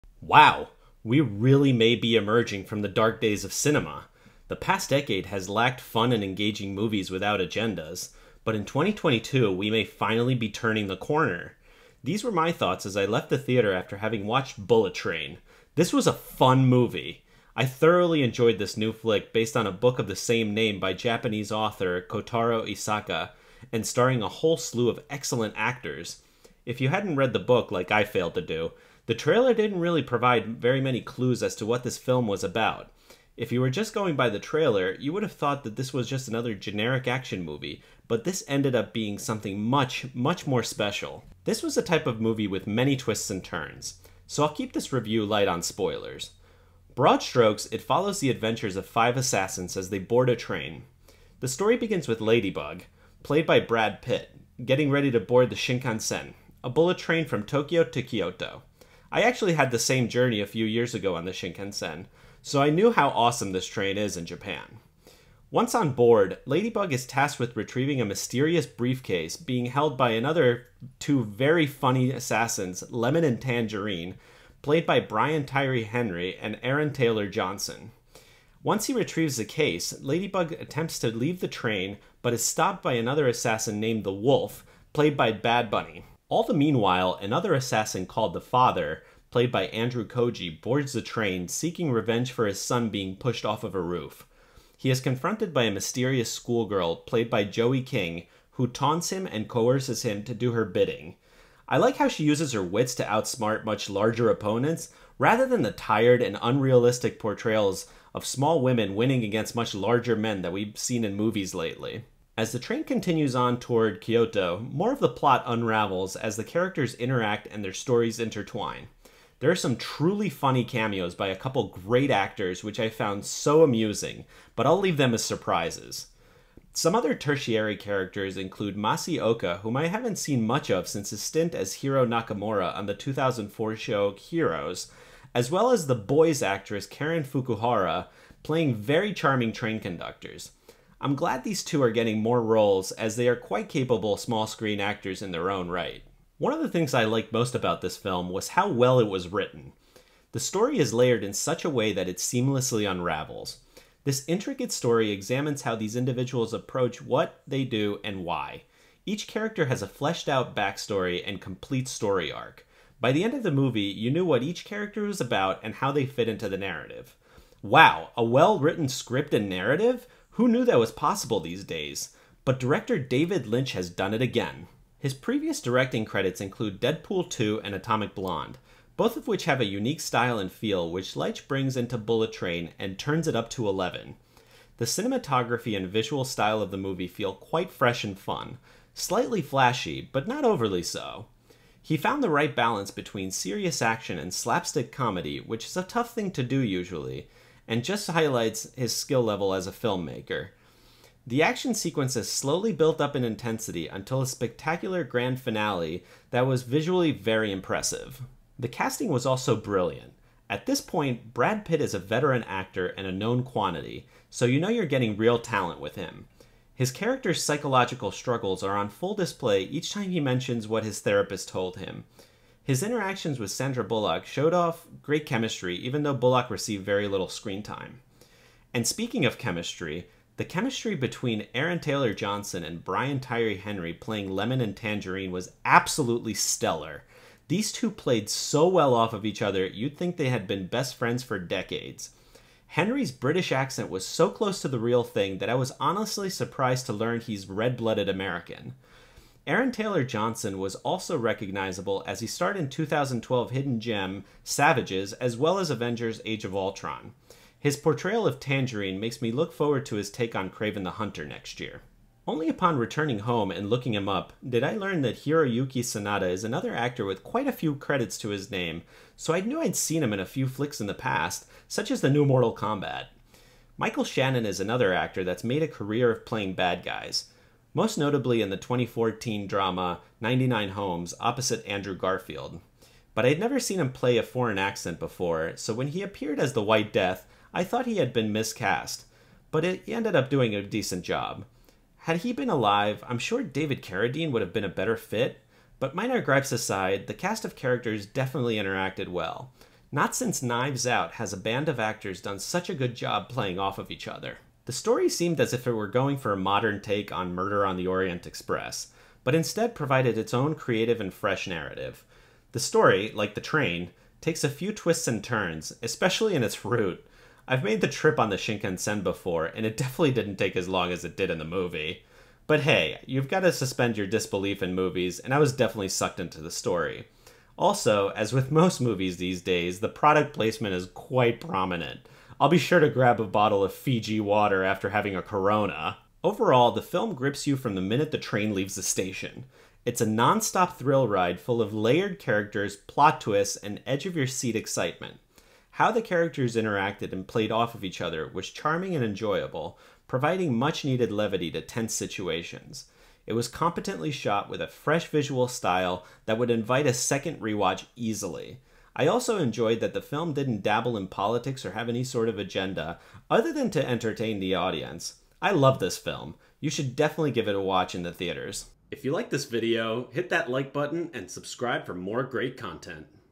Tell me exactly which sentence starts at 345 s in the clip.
How the characters interacted and played off of each other was charming and enjoyable, providing much needed levity to tense situations.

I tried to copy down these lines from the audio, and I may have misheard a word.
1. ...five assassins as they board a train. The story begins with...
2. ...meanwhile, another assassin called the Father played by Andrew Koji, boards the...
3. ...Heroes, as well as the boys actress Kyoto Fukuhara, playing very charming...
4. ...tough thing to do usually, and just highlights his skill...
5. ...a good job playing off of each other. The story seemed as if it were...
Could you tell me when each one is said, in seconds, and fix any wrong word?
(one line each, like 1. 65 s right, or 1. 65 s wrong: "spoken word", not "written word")
1. 48 s right
2. 86 s right
3. 134 s wrong: "Karen", not "Kyoto"
4. 195 s right
5. 302 s right.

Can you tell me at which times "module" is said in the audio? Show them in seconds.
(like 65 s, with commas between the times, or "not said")
not said.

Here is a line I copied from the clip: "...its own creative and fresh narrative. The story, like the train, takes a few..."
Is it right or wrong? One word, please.
right.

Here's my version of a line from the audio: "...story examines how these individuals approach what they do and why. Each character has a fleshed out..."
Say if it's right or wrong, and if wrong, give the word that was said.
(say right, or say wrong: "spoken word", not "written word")
right.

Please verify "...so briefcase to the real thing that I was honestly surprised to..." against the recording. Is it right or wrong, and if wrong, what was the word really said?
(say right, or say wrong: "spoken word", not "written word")
wrong: "close", not "briefcase".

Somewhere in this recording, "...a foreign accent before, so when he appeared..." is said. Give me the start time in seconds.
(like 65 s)
284 s.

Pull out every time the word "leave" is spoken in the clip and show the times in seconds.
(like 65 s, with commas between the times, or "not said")
81 s, 124 s, 338 s.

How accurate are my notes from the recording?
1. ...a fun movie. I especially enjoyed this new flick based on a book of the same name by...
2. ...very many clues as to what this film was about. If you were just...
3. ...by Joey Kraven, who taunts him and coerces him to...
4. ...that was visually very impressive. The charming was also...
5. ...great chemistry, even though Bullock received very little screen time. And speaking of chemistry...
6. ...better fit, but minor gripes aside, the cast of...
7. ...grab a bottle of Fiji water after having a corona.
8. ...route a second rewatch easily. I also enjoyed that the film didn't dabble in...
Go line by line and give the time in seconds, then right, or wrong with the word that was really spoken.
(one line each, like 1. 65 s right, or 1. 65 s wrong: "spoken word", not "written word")
1. 16 s wrong: "thoroughly", not "especially"
2. 30 s right
3. 97 s wrong: "King", not "Kraven"
4. 206 s wrong: "casting", not "charming"
5. 225 s right
6. 294 s right
7. 332 s right
8. 356 s wrong: "invite", not "route".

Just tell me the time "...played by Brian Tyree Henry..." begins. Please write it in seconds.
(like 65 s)
74 s.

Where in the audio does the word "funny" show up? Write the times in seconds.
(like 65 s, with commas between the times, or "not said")
71 s, 120 s.